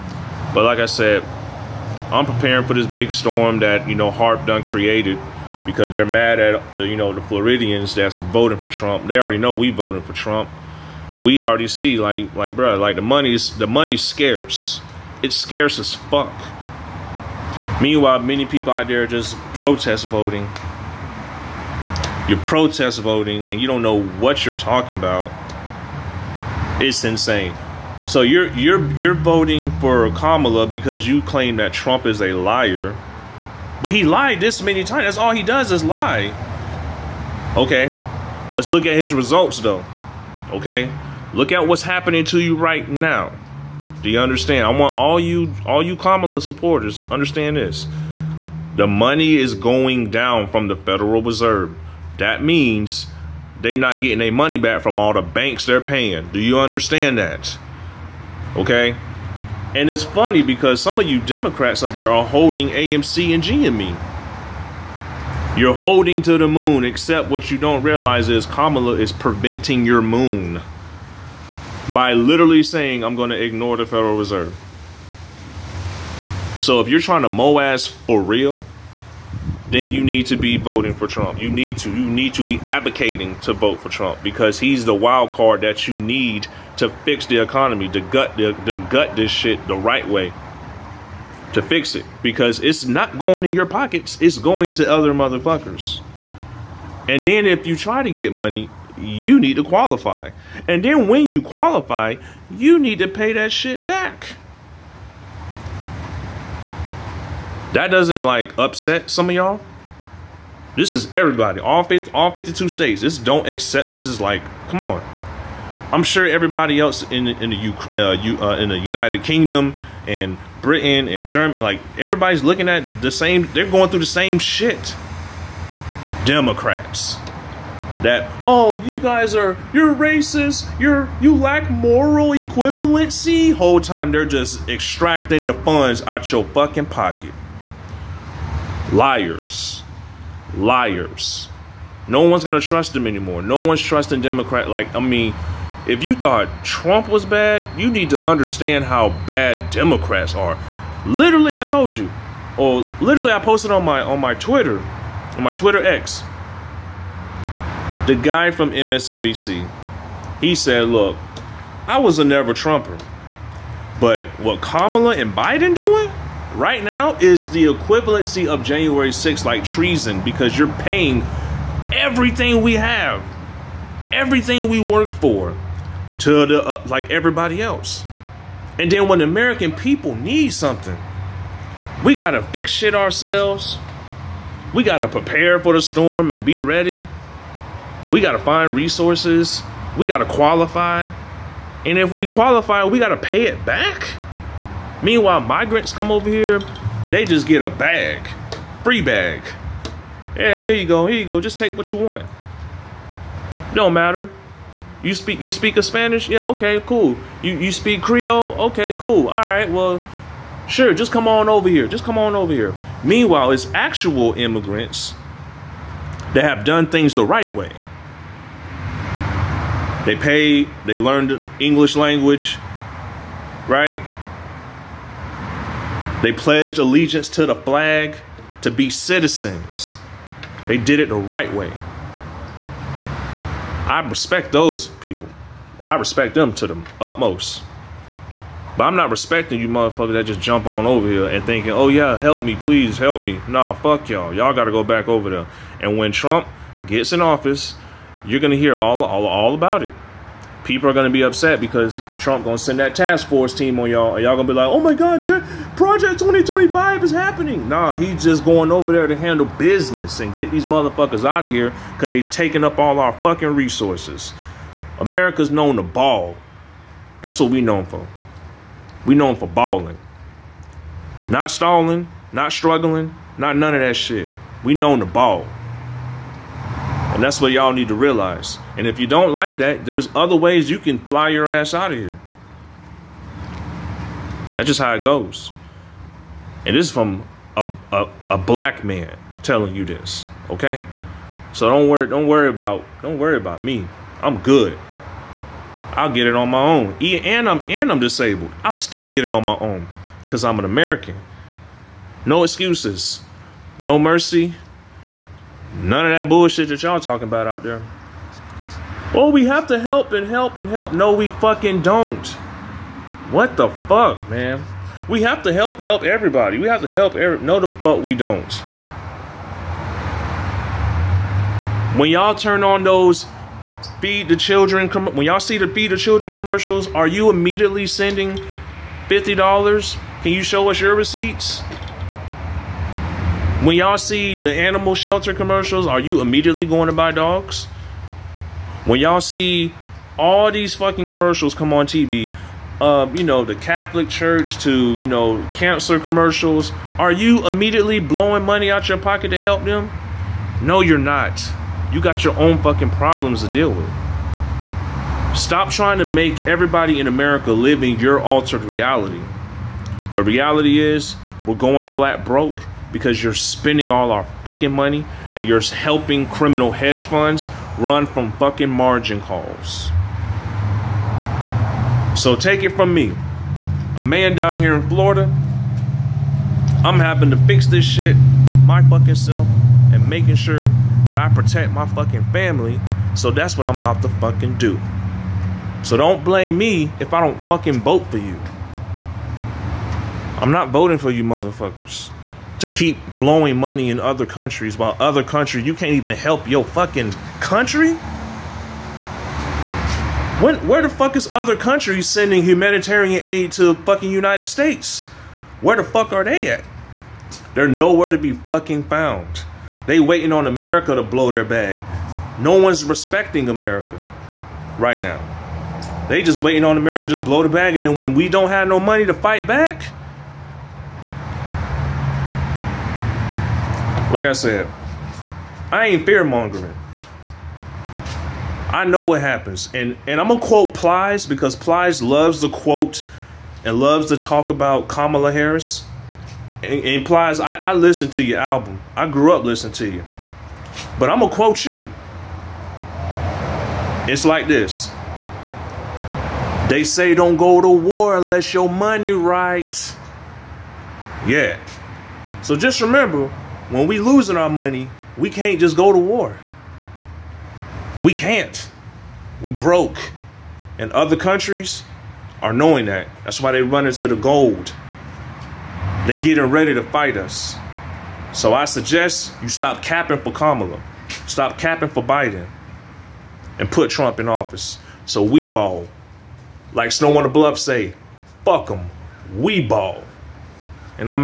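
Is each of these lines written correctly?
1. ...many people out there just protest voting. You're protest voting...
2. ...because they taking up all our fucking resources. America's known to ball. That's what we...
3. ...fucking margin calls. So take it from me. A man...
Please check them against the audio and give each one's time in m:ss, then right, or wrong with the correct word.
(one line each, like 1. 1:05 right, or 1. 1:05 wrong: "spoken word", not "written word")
1. 0:18 right
2. 4:21 right
3. 6:08 right.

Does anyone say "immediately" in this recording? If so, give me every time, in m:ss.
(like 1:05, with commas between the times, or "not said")
5:27, 5:36, 5:47.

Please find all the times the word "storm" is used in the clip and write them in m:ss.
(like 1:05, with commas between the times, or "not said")
0:03, 3:05.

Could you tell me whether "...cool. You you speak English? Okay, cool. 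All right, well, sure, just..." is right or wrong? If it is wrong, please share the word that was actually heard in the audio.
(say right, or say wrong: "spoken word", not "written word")
wrong: "Creole", not "English".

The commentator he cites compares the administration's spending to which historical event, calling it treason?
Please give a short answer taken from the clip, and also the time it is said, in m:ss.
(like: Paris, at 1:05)
January 6th, at 2:48.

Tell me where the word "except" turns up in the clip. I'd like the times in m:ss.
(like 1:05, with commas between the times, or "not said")
1:06.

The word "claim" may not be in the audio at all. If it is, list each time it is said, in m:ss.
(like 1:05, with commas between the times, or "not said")
0:31.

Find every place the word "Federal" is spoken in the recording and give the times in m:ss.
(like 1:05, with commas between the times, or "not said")
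0:50, 1:13.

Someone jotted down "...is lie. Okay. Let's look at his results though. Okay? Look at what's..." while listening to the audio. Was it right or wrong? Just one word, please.
right.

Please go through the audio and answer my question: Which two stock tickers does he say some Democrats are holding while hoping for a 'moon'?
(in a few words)
AMC and GME.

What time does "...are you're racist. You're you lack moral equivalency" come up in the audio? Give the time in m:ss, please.
2:09.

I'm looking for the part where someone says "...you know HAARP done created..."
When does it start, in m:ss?
0:03.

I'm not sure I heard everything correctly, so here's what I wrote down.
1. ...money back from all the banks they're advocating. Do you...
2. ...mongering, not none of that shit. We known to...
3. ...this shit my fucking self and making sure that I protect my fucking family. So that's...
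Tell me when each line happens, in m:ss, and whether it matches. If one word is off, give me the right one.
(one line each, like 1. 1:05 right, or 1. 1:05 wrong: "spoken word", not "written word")
1. 0:54 wrong: "paying", not "advocating"
2. 4:32 wrong: "struggling", not "mongering"
3. 6:17 right.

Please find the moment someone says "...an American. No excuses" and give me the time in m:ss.
5:00.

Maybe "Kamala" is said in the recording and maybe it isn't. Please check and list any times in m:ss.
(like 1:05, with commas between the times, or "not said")
0:30, 0:45, 1:08, 2:44, 7:14, 7:50.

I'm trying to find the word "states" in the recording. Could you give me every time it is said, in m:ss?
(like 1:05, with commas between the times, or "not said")
1:52, 6:44.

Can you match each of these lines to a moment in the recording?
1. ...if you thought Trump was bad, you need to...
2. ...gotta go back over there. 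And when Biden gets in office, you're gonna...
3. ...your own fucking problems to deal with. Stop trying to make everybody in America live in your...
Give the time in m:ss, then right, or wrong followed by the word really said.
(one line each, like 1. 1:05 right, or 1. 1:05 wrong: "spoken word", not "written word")
1. 2:25 right
2. 4:04 wrong: "Trump", not "Biden"
3. 5:52 right.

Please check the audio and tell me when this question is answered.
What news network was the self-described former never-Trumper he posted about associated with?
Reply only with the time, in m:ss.
2:38.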